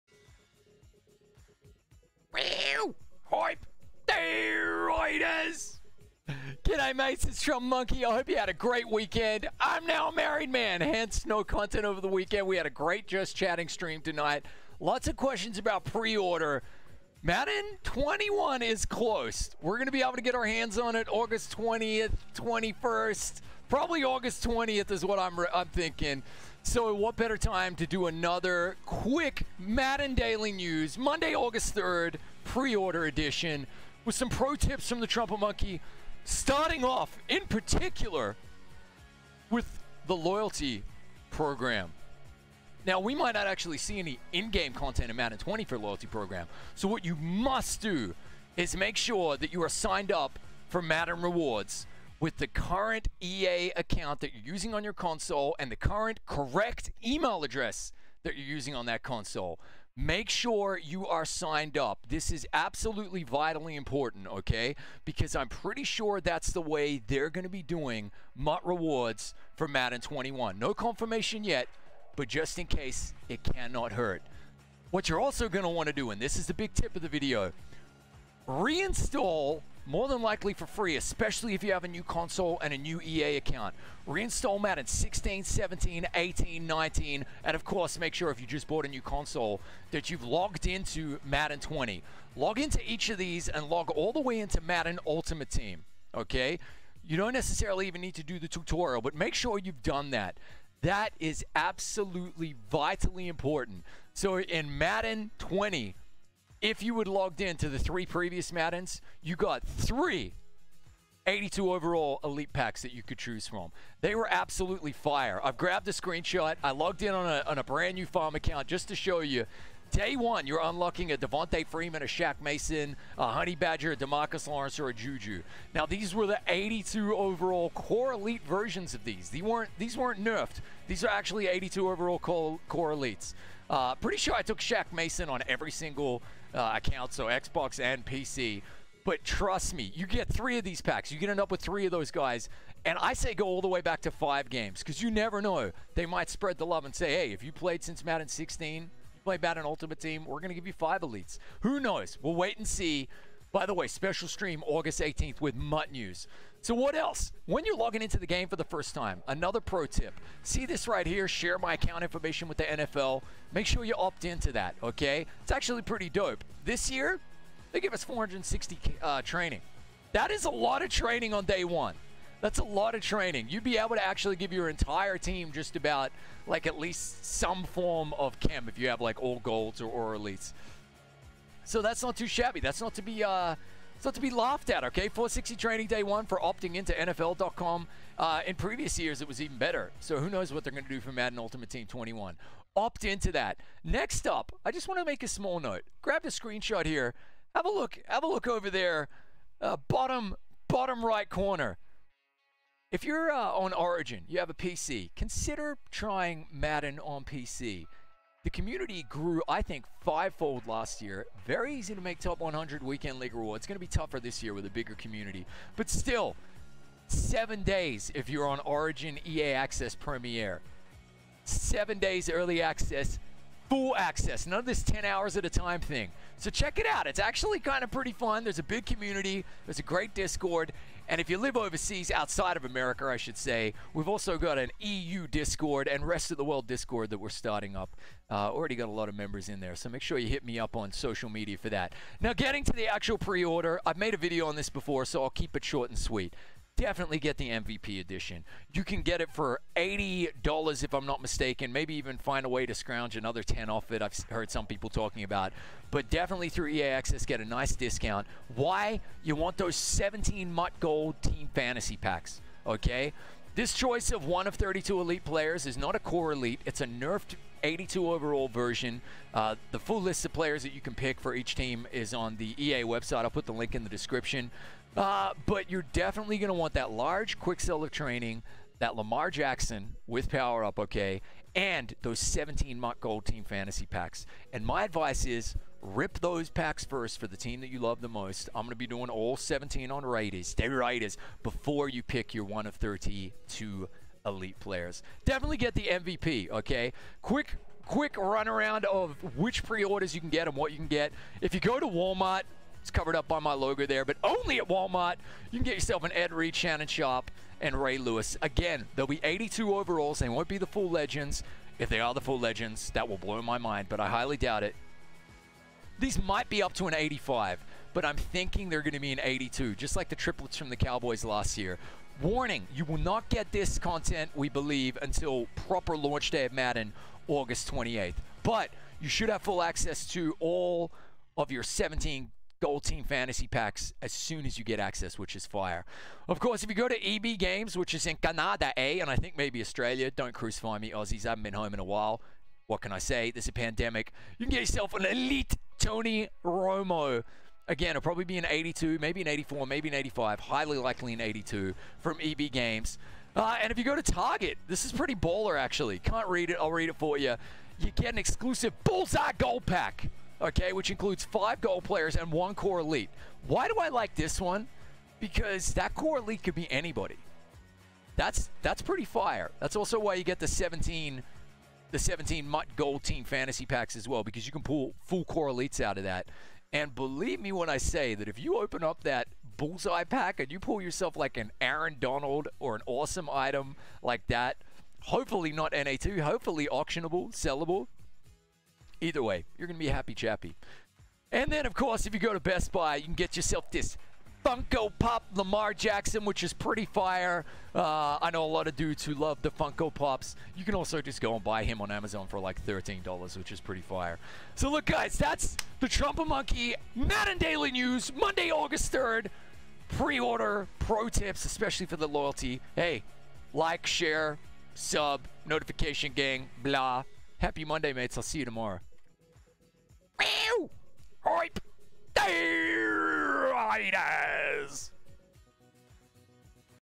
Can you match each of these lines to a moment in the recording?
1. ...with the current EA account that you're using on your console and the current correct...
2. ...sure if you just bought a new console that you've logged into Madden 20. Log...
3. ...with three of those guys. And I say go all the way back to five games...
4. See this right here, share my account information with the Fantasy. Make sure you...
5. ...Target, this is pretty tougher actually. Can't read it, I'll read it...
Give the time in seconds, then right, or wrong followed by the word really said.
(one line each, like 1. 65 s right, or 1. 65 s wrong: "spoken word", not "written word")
1. 52 s right
2. 88 s right
3. 141 s right
4. 160 s wrong: "NFL", not "Fantasy"
5. 354 s wrong: "baller", not "tougher".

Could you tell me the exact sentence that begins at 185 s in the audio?
460 training day one for opting into NFL.com.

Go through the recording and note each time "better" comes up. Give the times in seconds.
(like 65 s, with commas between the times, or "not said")
27 s, 189 s.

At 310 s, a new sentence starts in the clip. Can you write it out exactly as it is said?
They won't be the full legends.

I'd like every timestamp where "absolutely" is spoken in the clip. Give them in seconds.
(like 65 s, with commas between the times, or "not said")
62 s, 101 s, 114 s.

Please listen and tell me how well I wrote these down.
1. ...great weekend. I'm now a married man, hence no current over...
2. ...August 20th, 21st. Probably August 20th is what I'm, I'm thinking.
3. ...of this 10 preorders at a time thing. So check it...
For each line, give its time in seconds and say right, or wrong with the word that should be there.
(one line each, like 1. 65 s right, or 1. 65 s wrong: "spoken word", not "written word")
1. 8 s wrong: "content", not "current"
2. 21 s right
3. 224 s wrong: "hours", not "preorders".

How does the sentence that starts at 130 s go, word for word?
These are actually 82 overall core, core elites.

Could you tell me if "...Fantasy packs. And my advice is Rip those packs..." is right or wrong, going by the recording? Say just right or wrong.
right.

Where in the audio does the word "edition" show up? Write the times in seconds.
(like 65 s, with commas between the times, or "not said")
33 s, 247 s.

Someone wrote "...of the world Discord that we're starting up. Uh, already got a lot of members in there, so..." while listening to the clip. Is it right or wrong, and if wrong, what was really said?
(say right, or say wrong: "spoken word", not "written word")
right.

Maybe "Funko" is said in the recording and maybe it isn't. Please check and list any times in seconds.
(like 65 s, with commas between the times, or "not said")
394 s, 399 s.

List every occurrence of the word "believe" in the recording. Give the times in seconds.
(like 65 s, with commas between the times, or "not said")
324 s, 376 s.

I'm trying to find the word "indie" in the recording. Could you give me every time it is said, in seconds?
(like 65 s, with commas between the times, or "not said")
not said.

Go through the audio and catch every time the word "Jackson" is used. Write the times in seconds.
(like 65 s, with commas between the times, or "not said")
279 s, 395 s.